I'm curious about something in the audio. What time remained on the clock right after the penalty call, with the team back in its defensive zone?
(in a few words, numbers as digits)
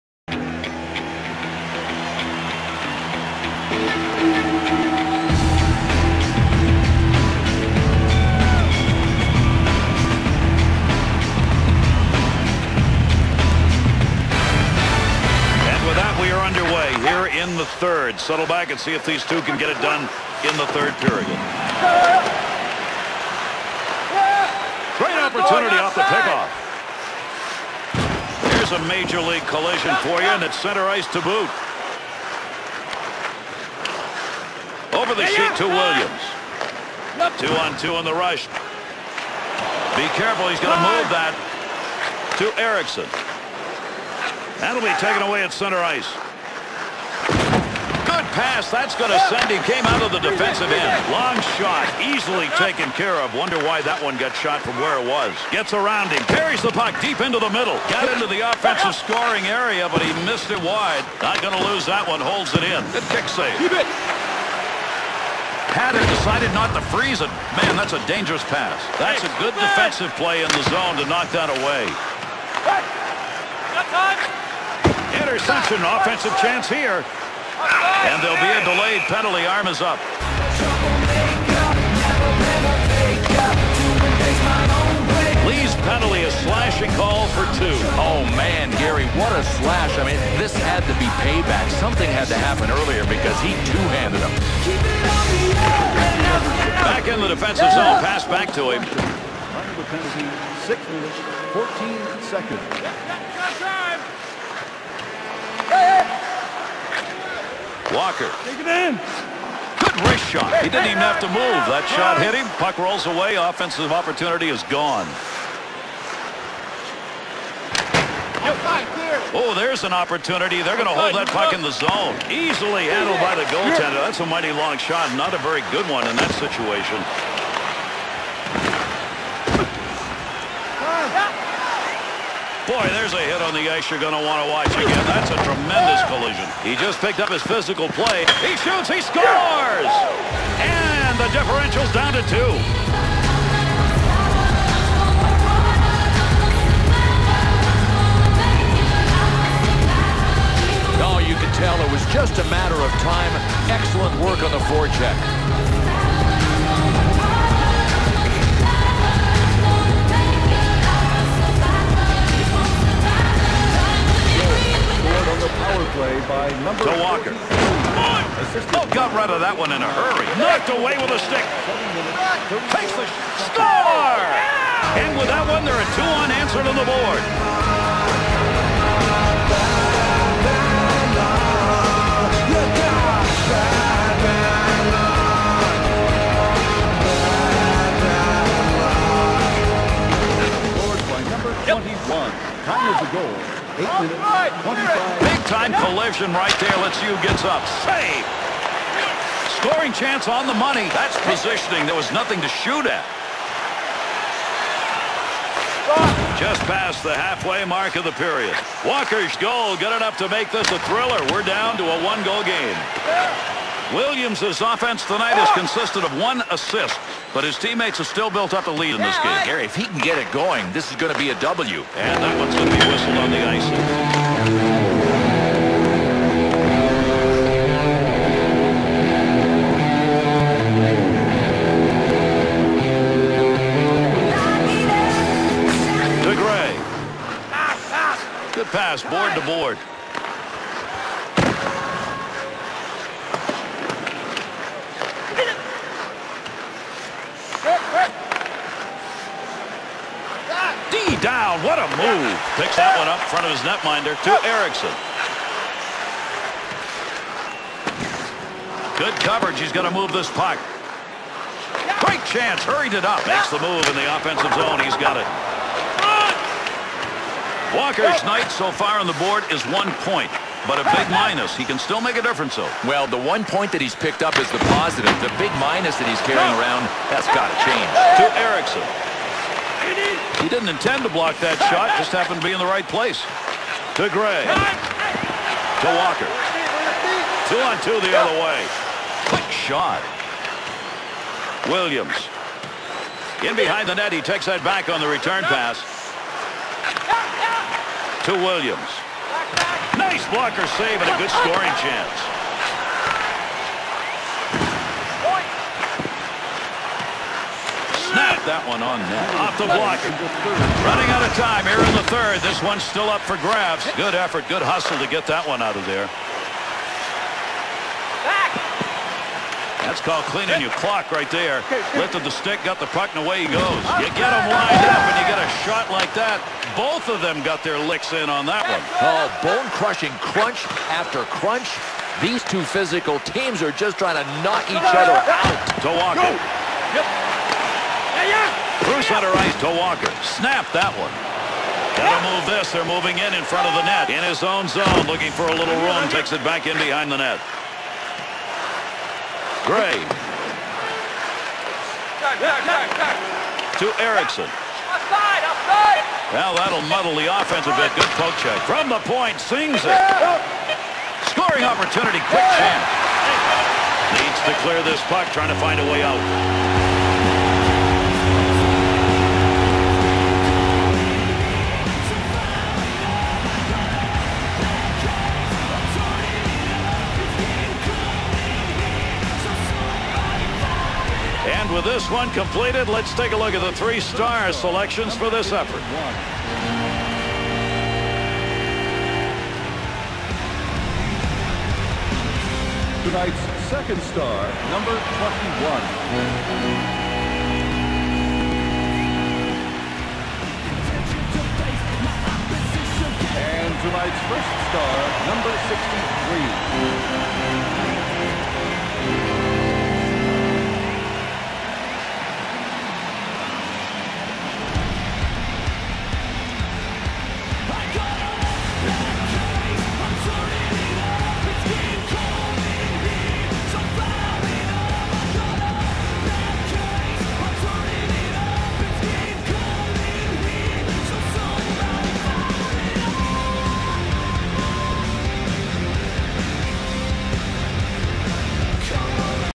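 6 minutes, 14 seconds.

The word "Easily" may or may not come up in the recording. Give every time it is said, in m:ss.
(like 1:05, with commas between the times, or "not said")
0:52, 2:02.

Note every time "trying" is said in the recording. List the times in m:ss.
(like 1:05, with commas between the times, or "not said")
5:33, 6:05.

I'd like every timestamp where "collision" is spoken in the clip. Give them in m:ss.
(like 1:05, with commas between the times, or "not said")
0:29, 2:16, 3:15.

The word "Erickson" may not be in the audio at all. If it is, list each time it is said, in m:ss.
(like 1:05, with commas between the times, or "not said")
0:42, 4:14, 4:38, 5:54.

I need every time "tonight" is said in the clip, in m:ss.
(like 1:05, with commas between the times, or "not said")
3:35, 6:33, 6:43.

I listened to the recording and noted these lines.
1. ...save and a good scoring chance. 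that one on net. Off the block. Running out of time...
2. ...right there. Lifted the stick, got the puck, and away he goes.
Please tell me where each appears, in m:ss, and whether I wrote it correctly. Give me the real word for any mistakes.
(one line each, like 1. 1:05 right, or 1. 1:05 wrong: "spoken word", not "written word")
1. 5:00 right
2. 5:21 right.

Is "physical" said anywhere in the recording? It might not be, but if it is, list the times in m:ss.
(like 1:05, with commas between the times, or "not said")
2:17, 5:32.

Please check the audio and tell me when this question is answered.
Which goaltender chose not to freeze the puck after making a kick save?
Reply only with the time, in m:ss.
1:05.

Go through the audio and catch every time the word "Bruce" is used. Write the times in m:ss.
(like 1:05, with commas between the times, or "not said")
5:38.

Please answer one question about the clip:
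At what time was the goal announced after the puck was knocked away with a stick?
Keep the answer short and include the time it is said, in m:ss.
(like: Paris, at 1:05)
8:25, at 3:13.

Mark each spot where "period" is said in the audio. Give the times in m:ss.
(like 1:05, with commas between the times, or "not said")
0:20, 3:28.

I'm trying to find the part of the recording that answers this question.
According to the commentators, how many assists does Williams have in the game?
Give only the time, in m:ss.
3:36.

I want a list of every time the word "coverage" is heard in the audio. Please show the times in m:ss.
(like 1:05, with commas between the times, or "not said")
4:19.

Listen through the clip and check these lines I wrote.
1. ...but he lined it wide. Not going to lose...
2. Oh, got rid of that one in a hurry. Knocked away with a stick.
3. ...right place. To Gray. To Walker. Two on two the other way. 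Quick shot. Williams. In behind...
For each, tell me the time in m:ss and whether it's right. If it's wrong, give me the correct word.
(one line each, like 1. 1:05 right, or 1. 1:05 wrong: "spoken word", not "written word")
1. 0:59 wrong: "missed", not "lined"
2. 2:47 right
3. 4:42 right.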